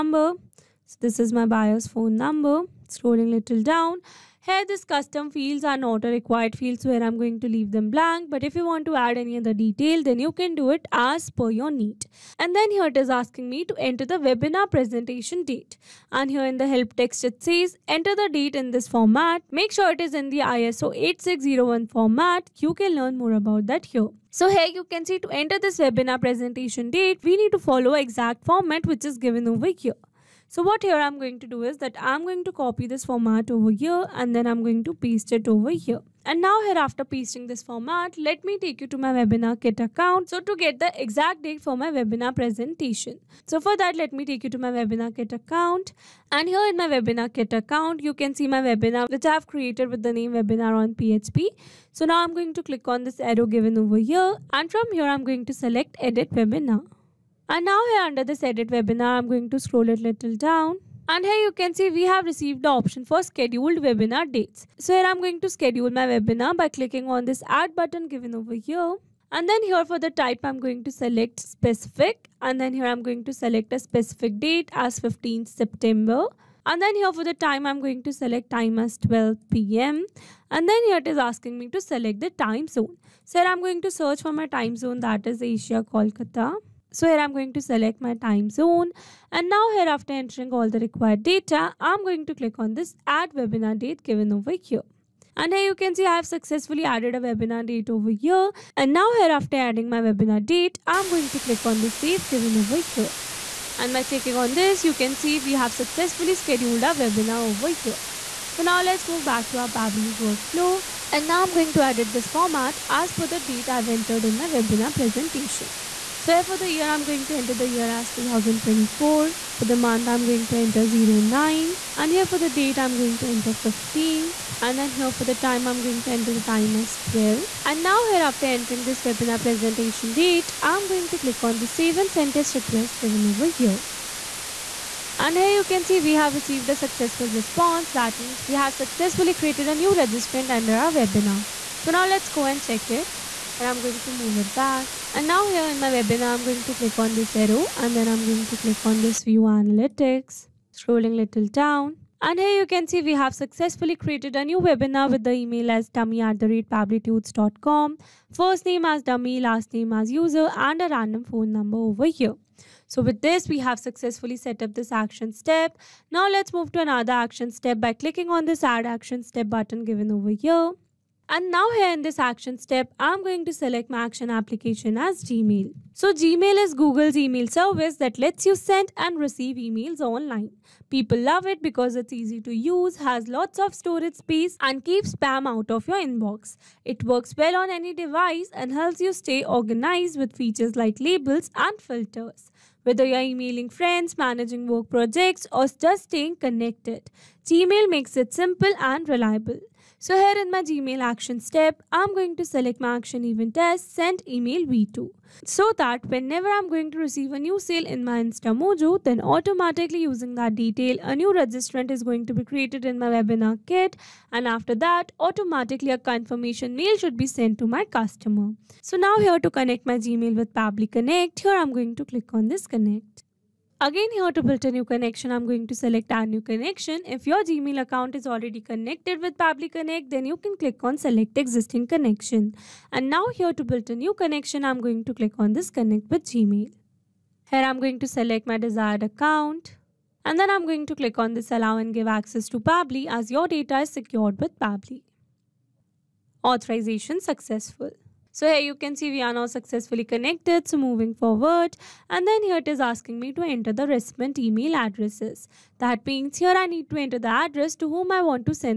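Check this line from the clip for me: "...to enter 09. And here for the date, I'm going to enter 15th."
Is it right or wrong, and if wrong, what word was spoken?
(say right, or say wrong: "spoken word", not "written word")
right.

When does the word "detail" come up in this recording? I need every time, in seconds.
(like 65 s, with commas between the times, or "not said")
9 s, 210 s.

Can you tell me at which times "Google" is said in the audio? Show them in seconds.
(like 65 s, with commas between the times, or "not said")
176 s.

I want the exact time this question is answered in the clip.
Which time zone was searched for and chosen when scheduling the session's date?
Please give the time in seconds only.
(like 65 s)
85 s.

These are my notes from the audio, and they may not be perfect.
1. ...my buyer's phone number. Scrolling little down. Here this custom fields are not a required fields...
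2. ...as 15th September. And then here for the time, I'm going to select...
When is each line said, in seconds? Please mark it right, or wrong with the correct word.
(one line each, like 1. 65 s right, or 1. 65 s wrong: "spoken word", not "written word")
1. 1 s right
2. 74 s right.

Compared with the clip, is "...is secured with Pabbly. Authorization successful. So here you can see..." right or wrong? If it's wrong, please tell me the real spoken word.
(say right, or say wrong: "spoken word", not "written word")
right.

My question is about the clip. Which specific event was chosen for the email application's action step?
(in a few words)
Send email v2.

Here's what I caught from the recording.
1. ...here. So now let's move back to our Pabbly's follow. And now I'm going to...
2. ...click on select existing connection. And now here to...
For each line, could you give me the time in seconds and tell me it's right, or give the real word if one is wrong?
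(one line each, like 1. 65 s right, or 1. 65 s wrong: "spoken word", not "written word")
1. 107 s wrong: "workflow", not "follow"
2. 230 s right.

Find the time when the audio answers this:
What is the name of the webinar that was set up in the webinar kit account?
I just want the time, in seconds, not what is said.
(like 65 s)
50 s.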